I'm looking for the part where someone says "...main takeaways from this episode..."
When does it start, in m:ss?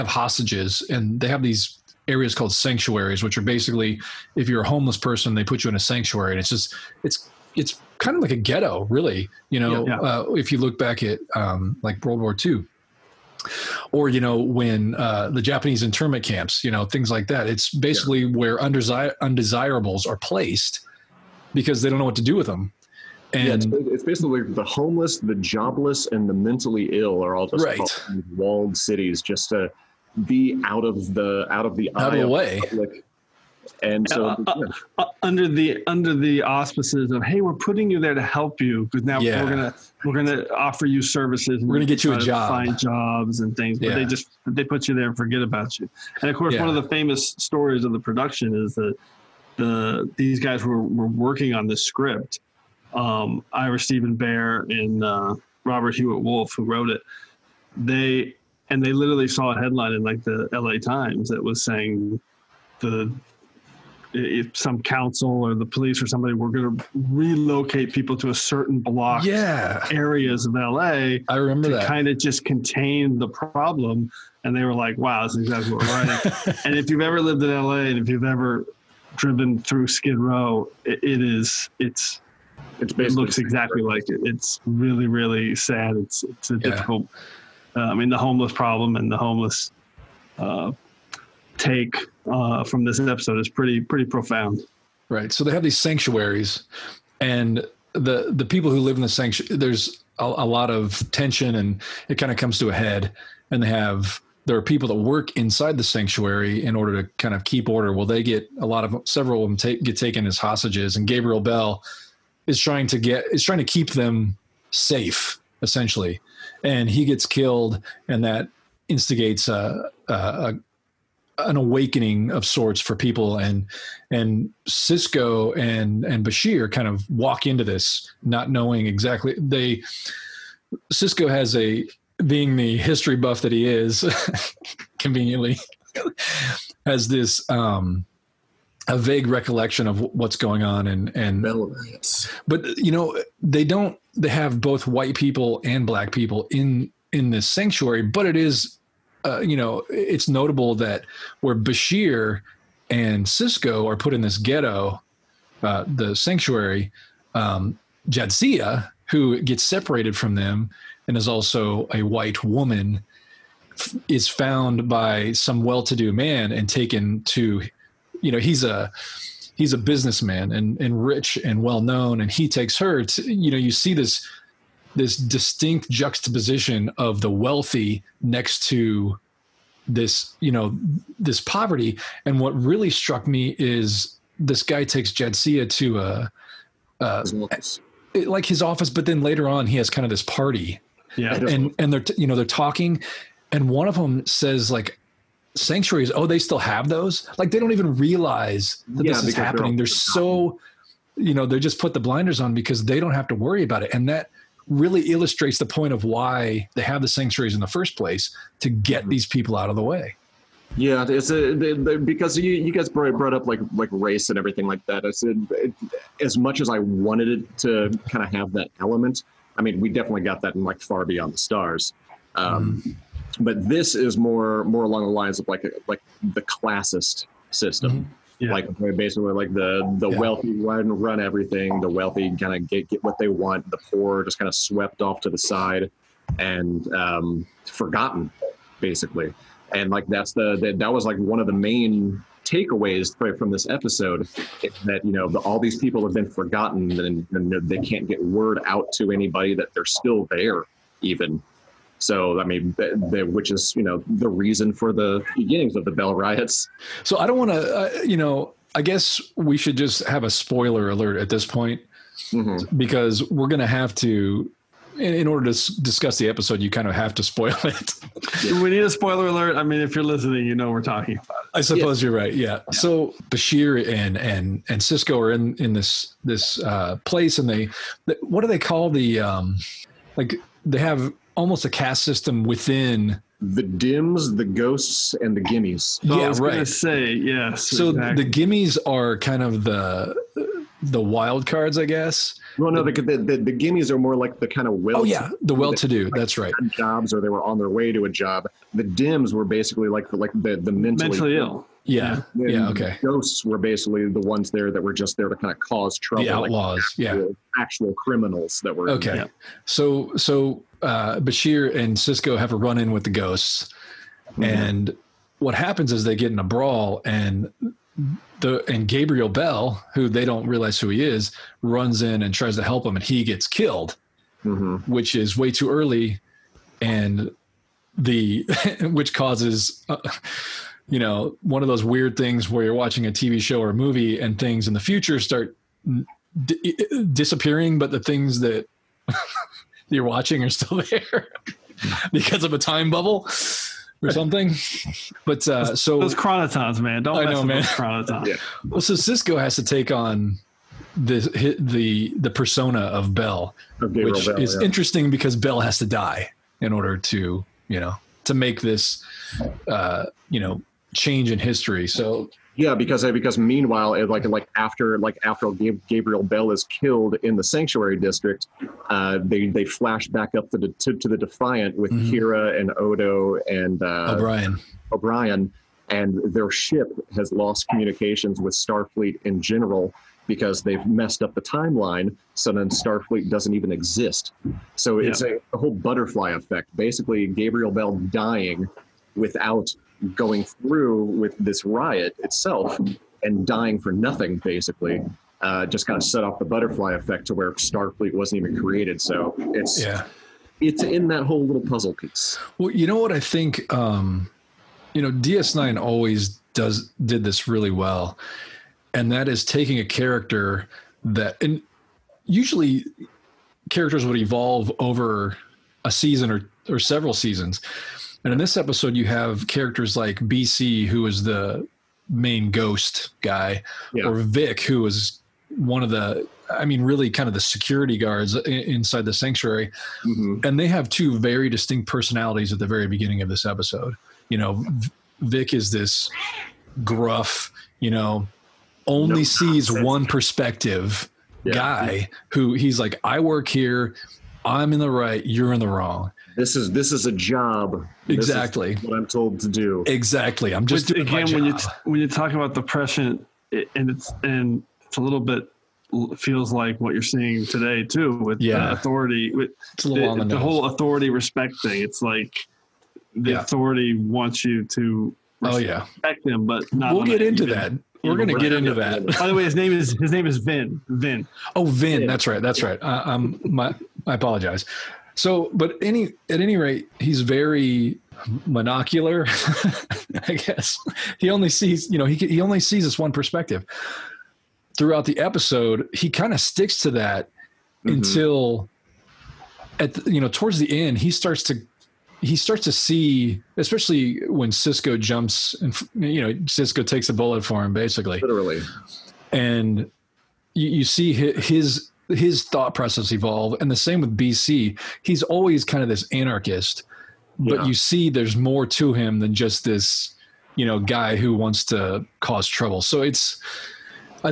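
4:01.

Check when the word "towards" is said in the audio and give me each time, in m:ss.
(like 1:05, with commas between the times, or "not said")
8:10.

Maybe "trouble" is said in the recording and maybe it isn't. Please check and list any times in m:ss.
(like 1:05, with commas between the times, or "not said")
5:05, 8:32.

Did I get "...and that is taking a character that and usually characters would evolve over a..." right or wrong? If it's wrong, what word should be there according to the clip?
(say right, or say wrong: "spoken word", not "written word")
right.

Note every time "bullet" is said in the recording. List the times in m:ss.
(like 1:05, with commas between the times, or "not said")
8:17.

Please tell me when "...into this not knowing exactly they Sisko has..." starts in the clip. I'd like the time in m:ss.
2:07.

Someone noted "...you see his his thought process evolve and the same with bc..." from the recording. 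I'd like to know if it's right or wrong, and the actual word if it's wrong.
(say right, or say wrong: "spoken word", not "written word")
right.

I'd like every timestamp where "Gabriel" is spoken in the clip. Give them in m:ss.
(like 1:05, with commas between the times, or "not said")
1:51, 5:18, 6:05, 6:27.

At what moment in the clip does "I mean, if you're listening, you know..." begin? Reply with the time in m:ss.
4:29.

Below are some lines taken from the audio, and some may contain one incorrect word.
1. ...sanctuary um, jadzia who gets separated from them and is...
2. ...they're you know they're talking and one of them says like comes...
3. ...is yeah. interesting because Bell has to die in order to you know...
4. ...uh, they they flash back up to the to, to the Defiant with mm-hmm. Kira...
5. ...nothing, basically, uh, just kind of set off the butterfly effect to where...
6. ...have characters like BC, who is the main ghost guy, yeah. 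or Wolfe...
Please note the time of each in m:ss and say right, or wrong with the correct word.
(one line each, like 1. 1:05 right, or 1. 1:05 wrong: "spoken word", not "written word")
1. 2:36 right
2. 3:11 wrong: "sanctuaries", not "comes"
3. 5:54 right
4. 6:08 right
5. 6:33 right
6. 6:59 wrong: "Vic", not "Wolfe".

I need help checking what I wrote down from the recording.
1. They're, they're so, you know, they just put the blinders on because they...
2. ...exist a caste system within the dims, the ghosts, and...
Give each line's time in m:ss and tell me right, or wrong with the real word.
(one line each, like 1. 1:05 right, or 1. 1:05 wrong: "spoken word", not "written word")
1. 3:19 right
2. 4:41 wrong: "almost", not "exist".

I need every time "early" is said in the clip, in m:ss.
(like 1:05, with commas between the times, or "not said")
5:25.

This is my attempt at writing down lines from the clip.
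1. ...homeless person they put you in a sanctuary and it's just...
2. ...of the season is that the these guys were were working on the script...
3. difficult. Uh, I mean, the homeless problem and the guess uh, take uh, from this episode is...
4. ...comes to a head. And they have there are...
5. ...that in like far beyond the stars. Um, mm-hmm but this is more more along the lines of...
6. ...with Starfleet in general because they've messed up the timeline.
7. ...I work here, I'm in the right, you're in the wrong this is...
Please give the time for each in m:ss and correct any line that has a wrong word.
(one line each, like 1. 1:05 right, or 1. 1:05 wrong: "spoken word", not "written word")
1. 0:04 right
2. 0:47 wrong: "production", not "season"
3. 1:26 wrong: "homeless", not "guess"
4. 1:42 right
5. 3:40 right
6. 6:18 right
7. 7:23 right.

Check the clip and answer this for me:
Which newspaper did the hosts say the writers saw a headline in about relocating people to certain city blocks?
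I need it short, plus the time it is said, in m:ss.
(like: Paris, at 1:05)
L.A. Times, at 1:00.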